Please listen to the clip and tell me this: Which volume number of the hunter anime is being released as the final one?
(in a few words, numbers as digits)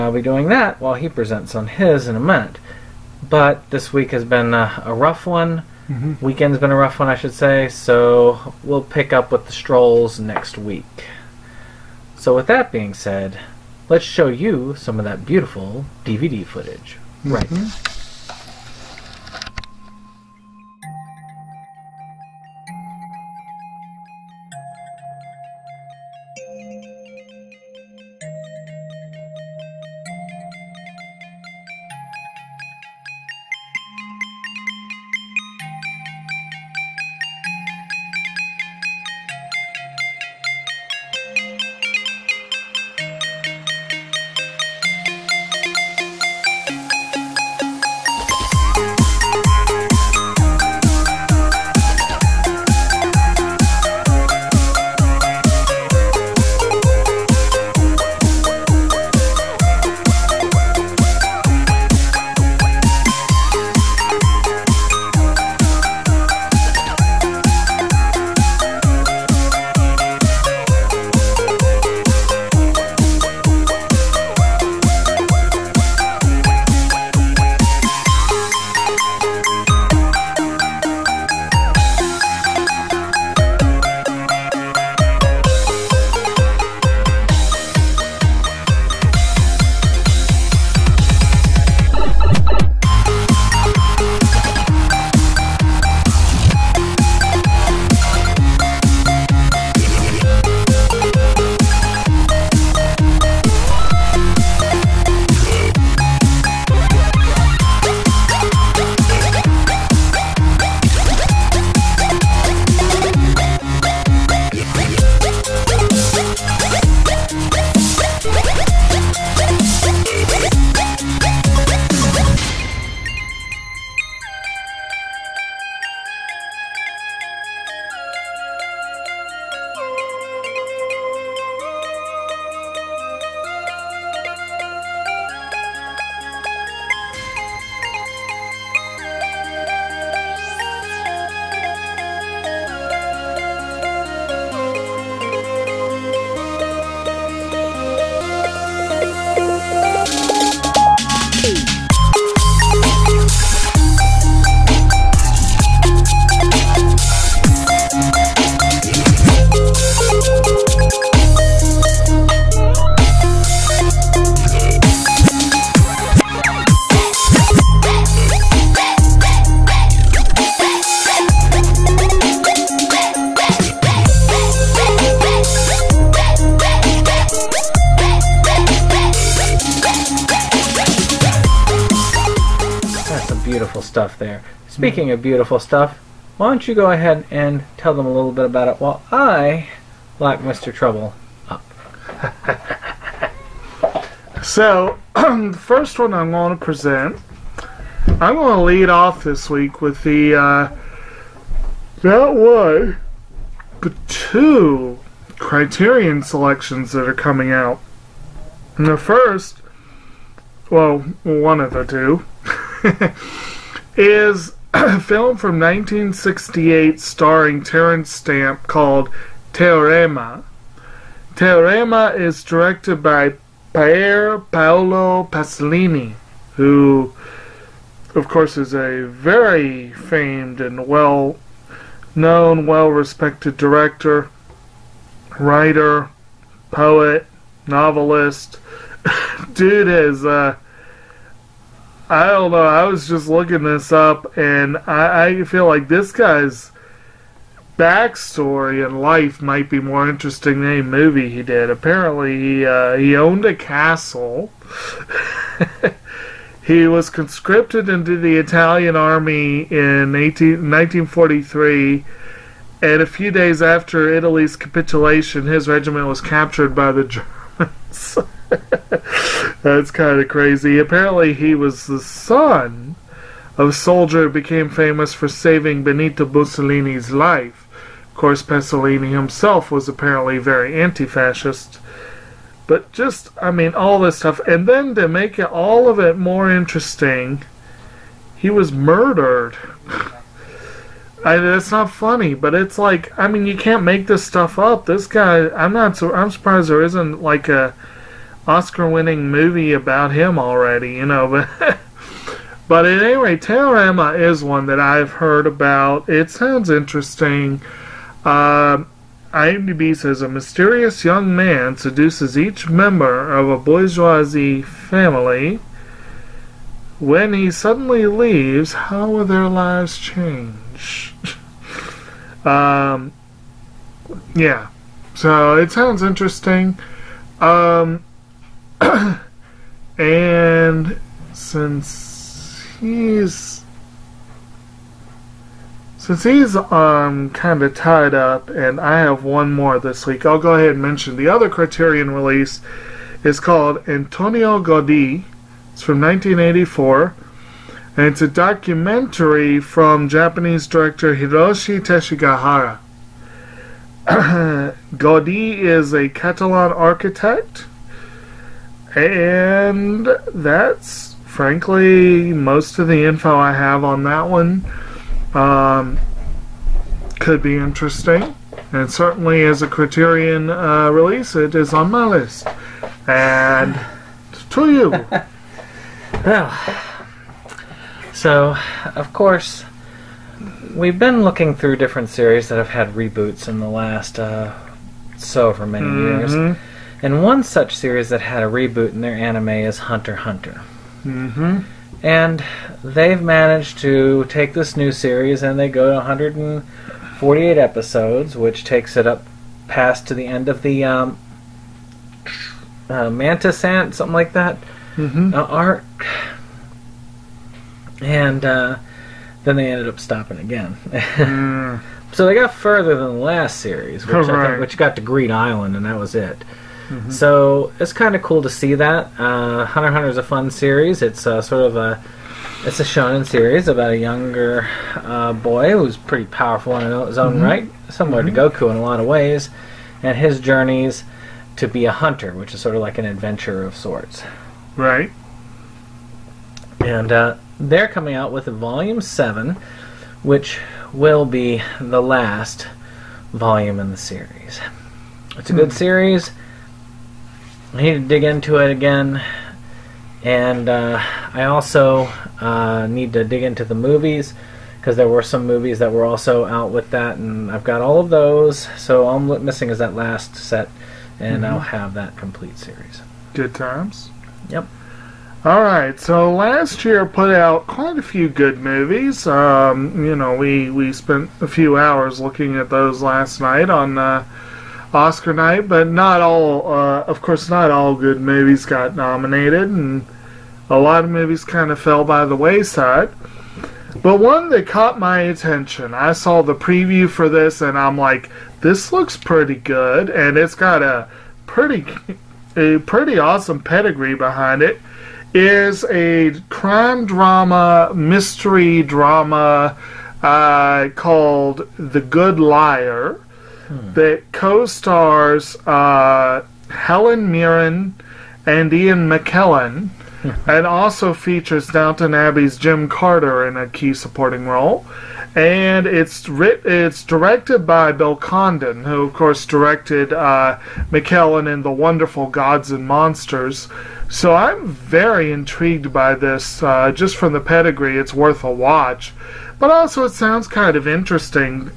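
7.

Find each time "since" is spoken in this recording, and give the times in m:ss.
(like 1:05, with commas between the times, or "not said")
5:31, 5:35.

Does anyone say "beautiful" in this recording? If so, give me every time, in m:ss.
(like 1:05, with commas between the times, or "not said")
0:15, 3:05.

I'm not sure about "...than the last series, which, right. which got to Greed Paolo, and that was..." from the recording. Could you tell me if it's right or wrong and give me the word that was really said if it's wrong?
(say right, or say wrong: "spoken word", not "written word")
wrong: "Island", not "Paolo".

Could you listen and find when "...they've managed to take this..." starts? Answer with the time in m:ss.
6:32.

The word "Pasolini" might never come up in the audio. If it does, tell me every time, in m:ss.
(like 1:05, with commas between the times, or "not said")
3:45, 4:38.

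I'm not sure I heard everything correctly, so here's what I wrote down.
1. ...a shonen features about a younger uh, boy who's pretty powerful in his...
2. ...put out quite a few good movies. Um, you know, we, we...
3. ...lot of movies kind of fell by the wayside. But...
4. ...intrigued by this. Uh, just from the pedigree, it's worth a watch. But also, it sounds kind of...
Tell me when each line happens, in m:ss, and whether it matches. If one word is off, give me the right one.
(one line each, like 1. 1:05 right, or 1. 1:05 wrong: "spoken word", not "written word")
1. 7:02 wrong: "series", not "features"
2. 7:47 right
3. 8:00 right
4. 8:45 right.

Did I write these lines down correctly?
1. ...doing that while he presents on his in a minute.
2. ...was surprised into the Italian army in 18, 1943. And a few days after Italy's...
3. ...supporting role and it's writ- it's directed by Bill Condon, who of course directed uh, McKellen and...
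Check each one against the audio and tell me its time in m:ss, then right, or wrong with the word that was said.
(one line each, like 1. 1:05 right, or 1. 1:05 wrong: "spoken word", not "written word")
1. 0:00 right
2. 4:16 wrong: "conscripted", not "surprised"
3. 8:33 right.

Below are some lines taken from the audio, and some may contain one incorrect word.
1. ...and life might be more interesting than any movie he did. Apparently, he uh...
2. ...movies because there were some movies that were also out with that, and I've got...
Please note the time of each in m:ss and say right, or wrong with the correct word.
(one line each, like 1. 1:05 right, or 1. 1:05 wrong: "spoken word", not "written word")
1. 4:08 right
2. 7:33 right.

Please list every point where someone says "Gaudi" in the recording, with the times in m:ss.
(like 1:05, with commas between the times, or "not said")
5:44, 5:54.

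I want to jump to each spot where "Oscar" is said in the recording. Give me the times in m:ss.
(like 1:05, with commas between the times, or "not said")
4:58, 7:54.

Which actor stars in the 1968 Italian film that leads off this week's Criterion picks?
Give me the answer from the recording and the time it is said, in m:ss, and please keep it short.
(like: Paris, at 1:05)
Terrence Stamp, at 3:37.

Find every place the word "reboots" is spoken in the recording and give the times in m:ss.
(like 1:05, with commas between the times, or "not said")
6:22, 6:28.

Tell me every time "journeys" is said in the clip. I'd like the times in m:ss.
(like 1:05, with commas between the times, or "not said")
7:10.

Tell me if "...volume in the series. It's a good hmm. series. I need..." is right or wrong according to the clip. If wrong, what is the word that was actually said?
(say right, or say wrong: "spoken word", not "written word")
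right.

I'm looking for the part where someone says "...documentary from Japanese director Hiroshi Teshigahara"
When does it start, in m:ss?
5:48.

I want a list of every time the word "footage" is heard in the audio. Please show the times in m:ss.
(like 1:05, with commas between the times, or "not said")
0:16.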